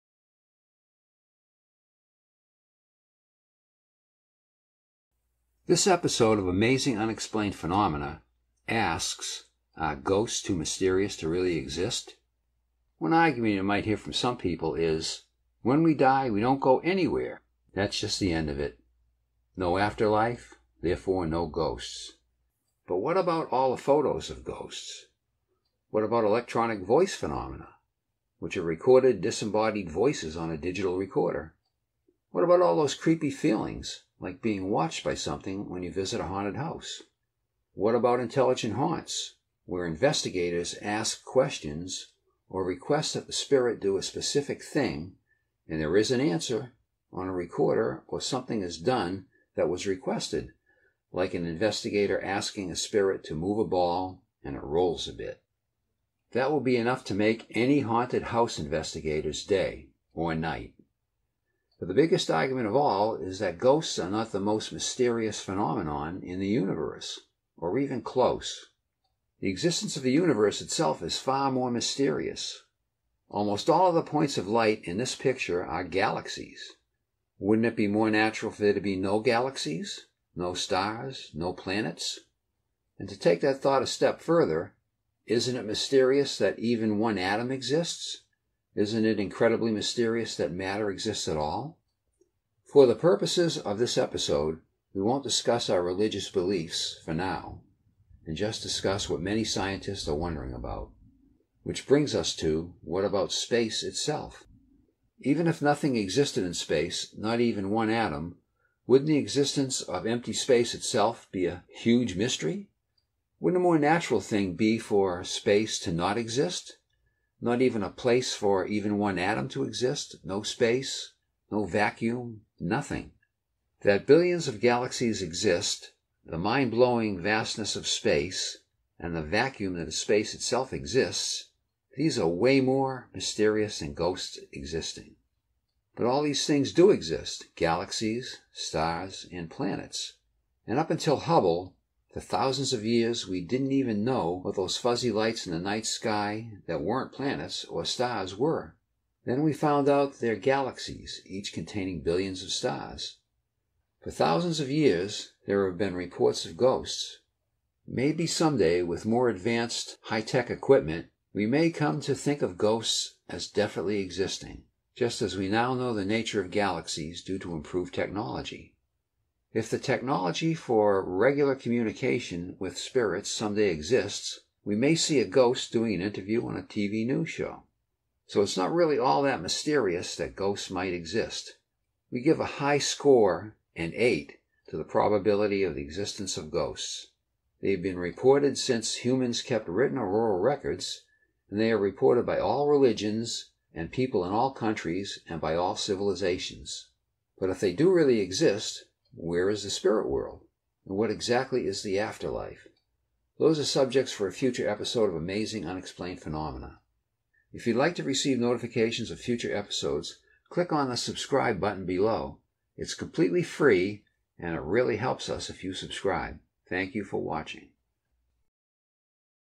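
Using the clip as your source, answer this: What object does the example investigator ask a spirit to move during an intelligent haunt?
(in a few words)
A ball.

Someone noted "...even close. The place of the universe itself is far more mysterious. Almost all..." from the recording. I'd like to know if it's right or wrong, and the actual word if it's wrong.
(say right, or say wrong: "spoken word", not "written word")
wrong: "existence", not "place".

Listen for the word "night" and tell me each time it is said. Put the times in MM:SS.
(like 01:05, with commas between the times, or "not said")
01:00, 02:25.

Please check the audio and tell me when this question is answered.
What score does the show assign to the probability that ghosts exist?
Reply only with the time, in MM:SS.
03:03.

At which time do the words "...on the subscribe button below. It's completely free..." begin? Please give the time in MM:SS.
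03:30.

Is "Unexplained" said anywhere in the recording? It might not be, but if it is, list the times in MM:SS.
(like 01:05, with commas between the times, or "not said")
00:06, 03:25.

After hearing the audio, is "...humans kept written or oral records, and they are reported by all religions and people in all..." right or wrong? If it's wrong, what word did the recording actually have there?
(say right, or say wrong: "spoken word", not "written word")
right.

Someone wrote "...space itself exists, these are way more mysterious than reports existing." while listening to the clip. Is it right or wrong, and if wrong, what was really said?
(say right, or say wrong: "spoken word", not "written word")
wrong: "ghosts", not "reports".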